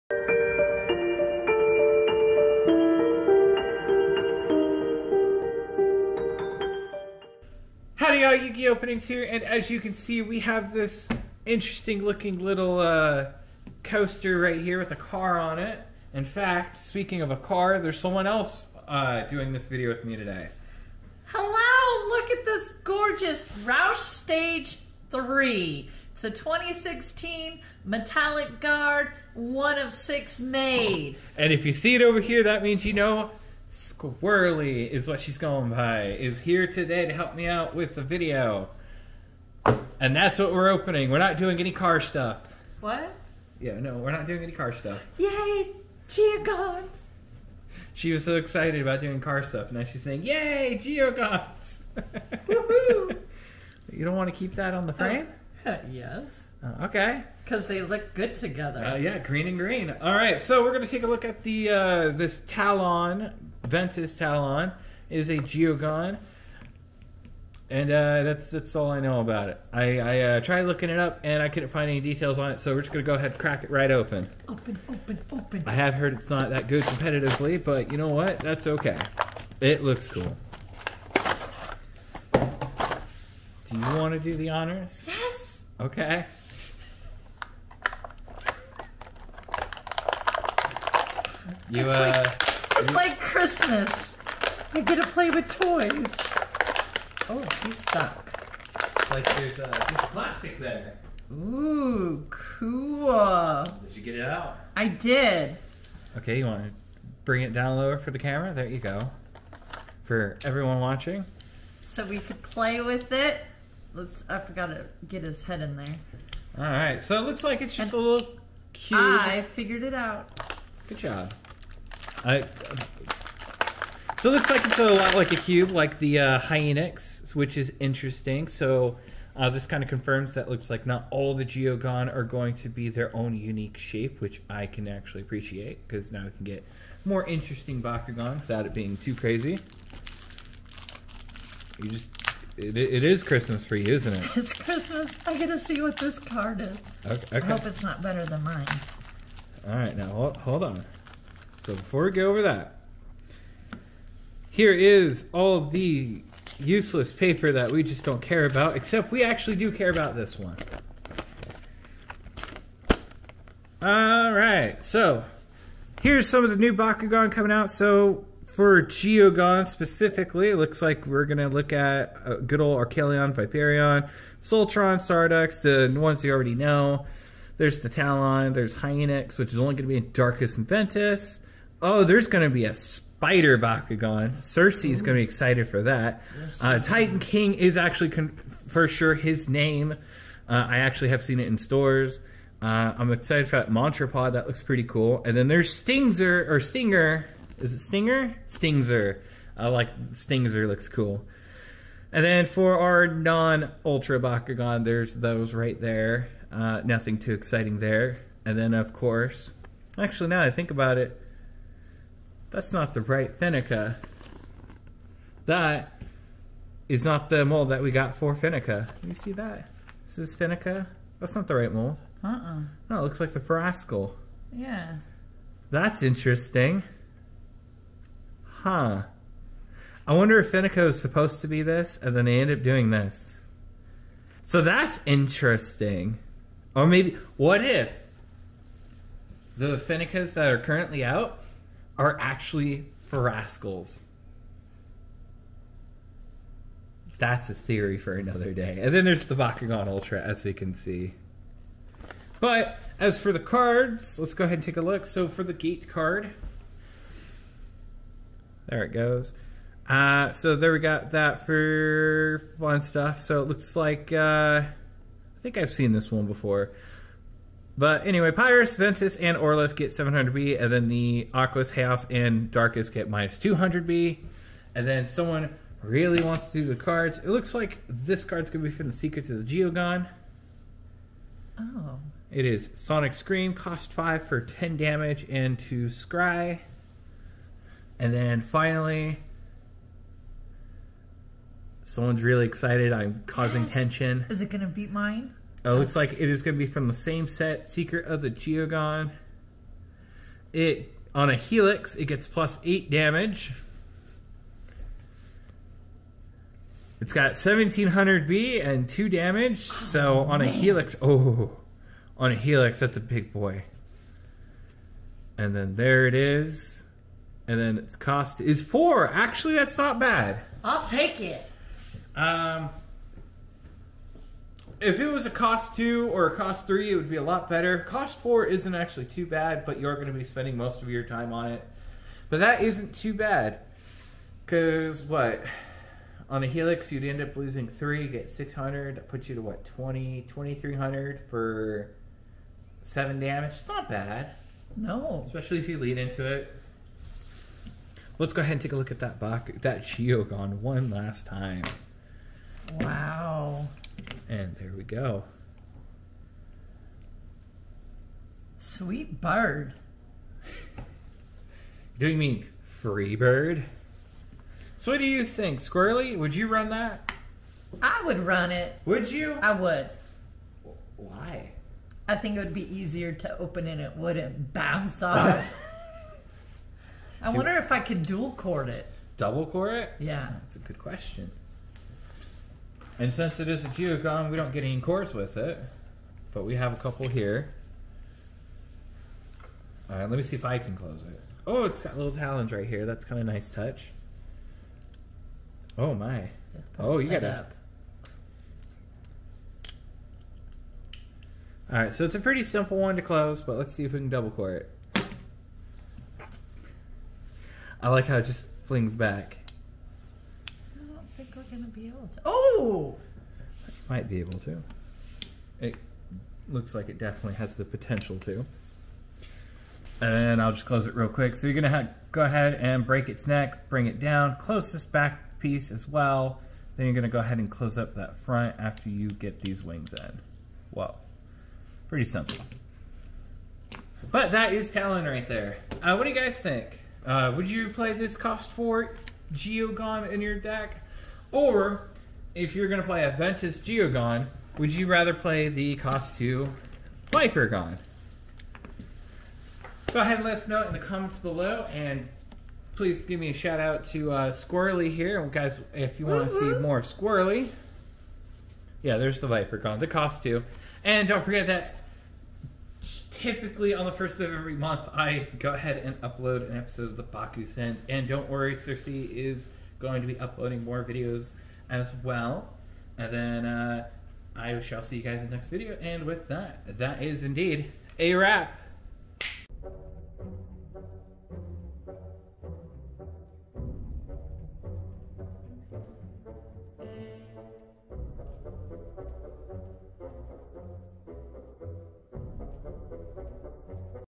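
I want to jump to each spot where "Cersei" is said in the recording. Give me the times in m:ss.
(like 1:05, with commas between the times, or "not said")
3:04, 7:48.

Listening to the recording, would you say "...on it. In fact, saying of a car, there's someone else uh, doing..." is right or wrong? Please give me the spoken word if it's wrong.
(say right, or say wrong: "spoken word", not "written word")
wrong: "speaking", not "saying".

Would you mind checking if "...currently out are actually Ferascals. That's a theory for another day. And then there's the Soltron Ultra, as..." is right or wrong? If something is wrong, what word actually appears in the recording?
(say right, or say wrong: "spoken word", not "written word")
wrong: "Bakugan", not "Soltron".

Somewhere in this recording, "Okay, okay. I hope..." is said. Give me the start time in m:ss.
2:27.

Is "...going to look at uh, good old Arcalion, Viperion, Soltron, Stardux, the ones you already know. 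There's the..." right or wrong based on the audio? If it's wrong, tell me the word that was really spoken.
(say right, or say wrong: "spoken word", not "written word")
right.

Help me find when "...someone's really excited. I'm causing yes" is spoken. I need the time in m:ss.
4:51.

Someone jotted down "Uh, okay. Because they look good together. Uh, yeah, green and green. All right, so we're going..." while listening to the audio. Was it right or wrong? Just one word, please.
right.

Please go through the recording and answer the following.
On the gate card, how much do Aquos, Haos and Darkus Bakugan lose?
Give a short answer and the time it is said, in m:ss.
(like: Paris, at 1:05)
200B, at 4:33.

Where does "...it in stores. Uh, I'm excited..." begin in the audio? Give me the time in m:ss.
3:11.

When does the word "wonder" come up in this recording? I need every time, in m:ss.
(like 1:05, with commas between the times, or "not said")
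3:50, 6:17.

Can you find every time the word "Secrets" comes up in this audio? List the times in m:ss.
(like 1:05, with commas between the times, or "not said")
4:38, 4:57.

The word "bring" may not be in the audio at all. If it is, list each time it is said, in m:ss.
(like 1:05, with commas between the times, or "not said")
1:47, 7:03.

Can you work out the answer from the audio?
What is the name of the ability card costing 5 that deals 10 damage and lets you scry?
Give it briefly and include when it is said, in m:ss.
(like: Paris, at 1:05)
Sonic Scream, at 4:42.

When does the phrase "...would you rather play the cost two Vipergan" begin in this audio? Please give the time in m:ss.
7:24.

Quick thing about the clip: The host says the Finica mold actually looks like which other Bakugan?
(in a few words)
Ferascal.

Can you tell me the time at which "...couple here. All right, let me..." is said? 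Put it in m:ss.
6:26.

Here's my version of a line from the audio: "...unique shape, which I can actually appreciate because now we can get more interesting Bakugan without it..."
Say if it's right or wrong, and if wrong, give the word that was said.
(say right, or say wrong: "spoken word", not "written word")
right.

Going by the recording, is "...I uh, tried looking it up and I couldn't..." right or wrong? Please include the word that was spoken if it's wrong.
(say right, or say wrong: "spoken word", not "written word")
right.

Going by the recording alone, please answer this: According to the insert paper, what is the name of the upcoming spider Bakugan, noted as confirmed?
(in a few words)
Titan King.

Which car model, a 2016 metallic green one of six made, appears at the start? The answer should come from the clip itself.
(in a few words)
Roush Stage 3.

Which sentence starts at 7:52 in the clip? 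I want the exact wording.
And then uh, I shall see you guys in the next video.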